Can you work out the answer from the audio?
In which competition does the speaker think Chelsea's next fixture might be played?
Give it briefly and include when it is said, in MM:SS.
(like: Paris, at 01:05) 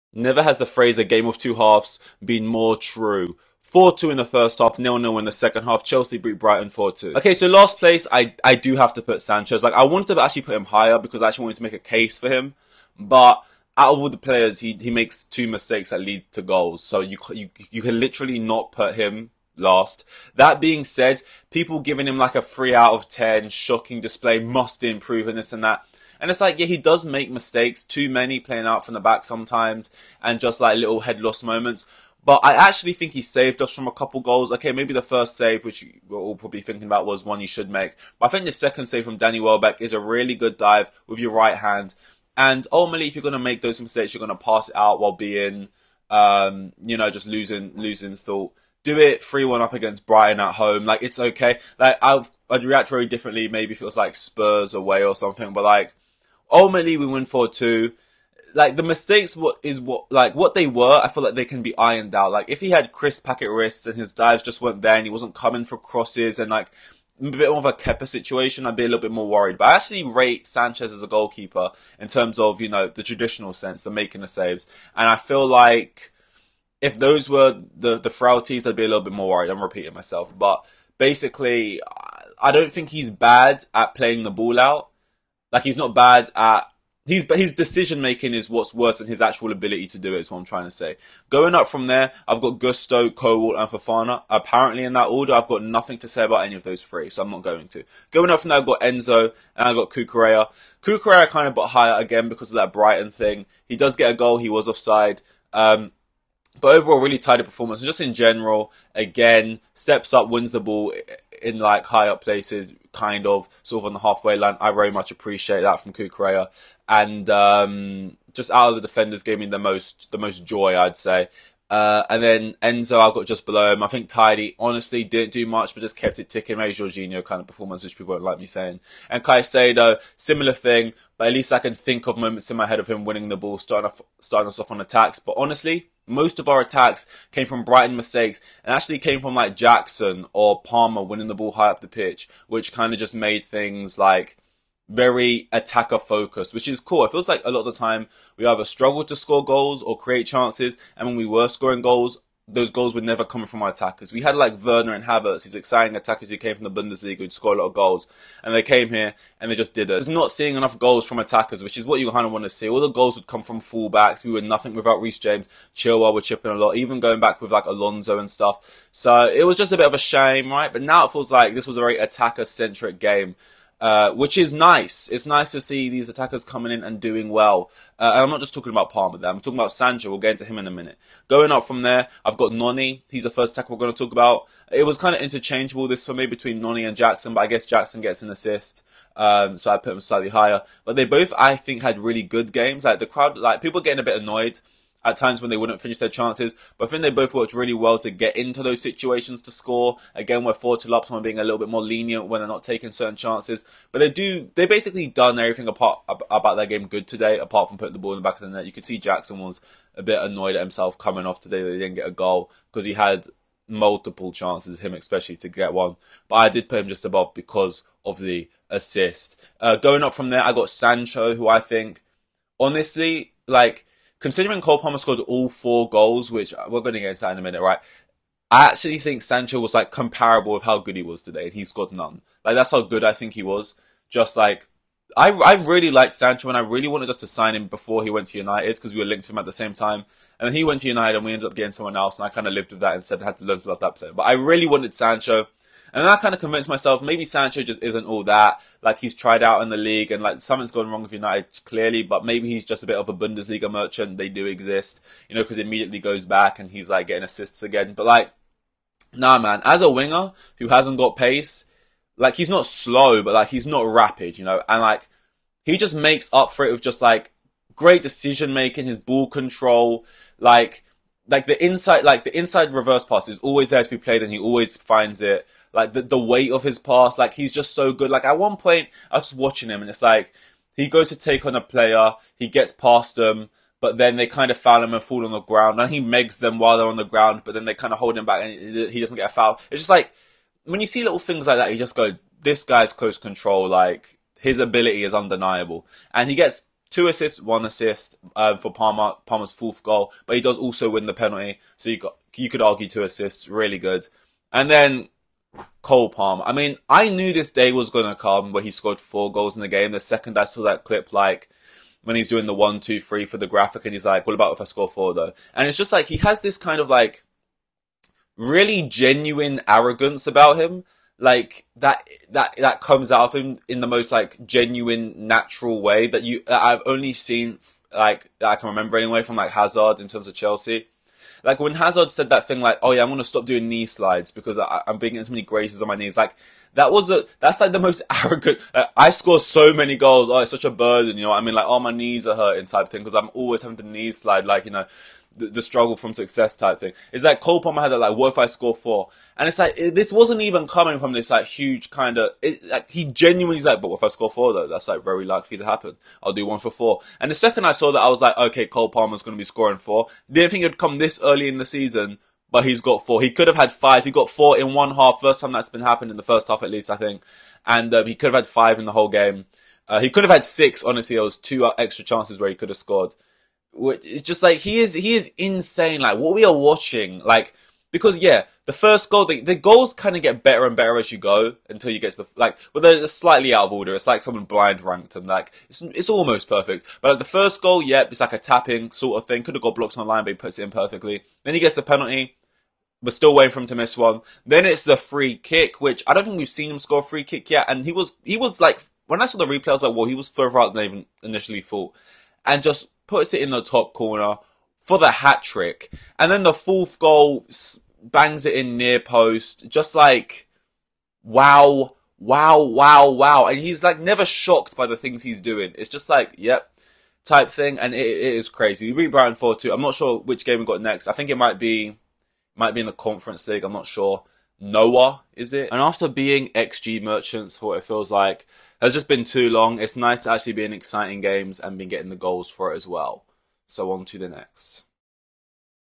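Conference League, at 07:02.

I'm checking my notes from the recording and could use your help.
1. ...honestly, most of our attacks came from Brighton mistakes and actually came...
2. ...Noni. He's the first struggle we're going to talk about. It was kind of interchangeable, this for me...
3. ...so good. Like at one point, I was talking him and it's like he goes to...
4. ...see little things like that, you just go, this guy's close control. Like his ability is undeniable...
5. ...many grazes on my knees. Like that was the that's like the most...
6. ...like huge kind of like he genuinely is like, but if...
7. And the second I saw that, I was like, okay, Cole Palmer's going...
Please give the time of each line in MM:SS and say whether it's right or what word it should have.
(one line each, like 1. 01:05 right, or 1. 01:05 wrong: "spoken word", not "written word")
1. 02:15 right
2. 03:02 wrong: "tackle", not "struggle"
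3. 04:37 wrong: "watching", not "talking"
4. 04:50 right
5. 05:35 right
6. 05:51 right
7. 05:57 right.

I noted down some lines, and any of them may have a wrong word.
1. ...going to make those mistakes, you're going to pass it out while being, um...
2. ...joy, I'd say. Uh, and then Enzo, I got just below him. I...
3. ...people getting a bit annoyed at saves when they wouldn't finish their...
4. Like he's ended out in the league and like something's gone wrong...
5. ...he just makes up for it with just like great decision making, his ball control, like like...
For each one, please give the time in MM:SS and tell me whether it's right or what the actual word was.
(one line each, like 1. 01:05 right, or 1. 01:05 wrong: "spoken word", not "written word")
1. 00:43 right
2. 02:00 right
3. 03:13 wrong: "times", not "saves"
4. 04:08 wrong: "tried", not "ended"
5. 04:25 right.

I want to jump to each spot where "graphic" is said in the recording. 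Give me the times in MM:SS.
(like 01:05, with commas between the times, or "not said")
05:13.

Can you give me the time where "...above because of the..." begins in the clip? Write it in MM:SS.
03:37.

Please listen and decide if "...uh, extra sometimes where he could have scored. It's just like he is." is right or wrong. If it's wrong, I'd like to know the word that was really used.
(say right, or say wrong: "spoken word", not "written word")
wrong: "chances", not "sometimes".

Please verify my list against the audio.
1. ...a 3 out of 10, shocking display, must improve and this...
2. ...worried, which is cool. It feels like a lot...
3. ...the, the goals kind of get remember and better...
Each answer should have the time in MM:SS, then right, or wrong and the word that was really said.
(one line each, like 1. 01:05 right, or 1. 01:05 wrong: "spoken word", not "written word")
1. 00:22 right
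2. 02:25 wrong: "focused", not "worried"
3. 06:19 wrong: "better", not "remember".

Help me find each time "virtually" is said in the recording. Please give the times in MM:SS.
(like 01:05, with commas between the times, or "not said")
not said.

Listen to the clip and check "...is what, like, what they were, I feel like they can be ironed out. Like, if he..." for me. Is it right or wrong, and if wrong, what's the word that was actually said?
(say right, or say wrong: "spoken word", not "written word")
right.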